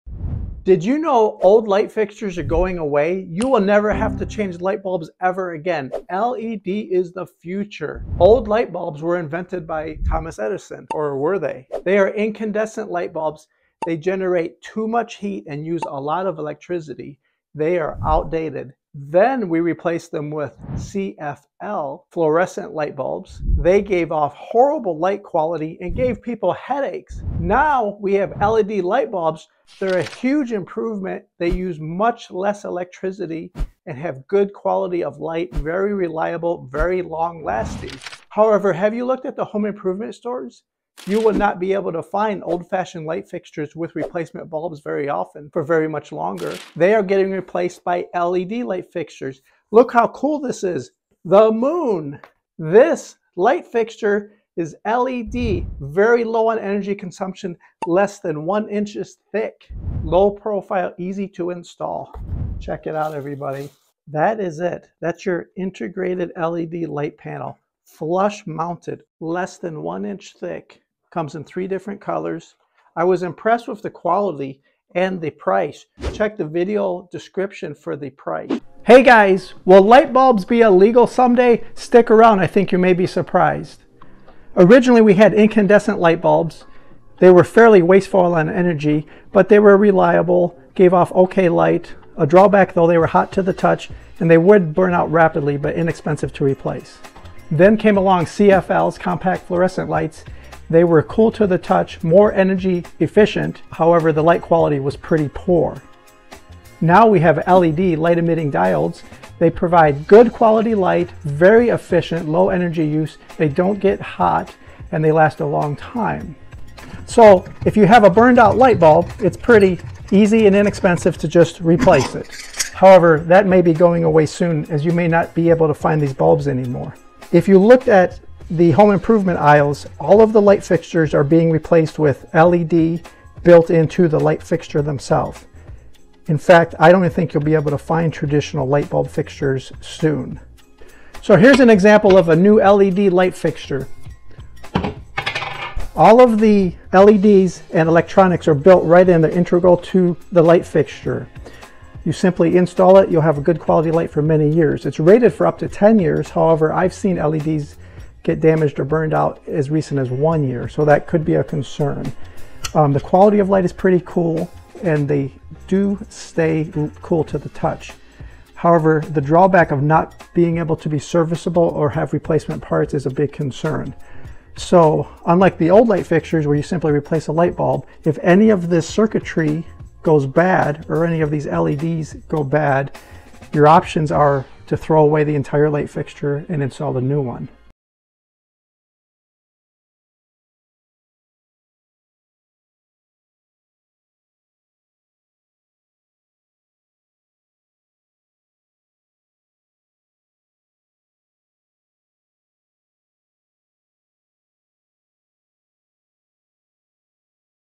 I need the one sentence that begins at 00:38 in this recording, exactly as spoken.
However, have you looked at the home improvement stores?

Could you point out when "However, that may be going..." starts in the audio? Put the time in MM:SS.
02:02.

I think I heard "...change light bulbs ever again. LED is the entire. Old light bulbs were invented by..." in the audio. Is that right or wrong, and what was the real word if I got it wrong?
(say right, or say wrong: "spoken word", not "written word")
wrong: "future", not "entire".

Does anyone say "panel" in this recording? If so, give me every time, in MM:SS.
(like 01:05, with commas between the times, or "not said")
01:07.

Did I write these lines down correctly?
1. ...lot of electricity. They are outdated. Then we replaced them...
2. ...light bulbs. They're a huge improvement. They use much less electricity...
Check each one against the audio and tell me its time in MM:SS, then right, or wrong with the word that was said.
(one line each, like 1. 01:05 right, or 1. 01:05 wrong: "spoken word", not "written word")
1. 00:15 right
2. 00:28 right.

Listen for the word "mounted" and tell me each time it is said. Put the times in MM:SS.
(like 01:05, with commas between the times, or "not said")
01:08.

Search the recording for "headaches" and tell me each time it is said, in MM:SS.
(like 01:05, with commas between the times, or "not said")
00:26.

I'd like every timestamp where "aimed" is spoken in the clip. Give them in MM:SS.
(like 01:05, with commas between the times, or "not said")
not said.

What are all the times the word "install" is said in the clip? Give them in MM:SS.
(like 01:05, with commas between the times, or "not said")
01:01, 02:32, 03:06.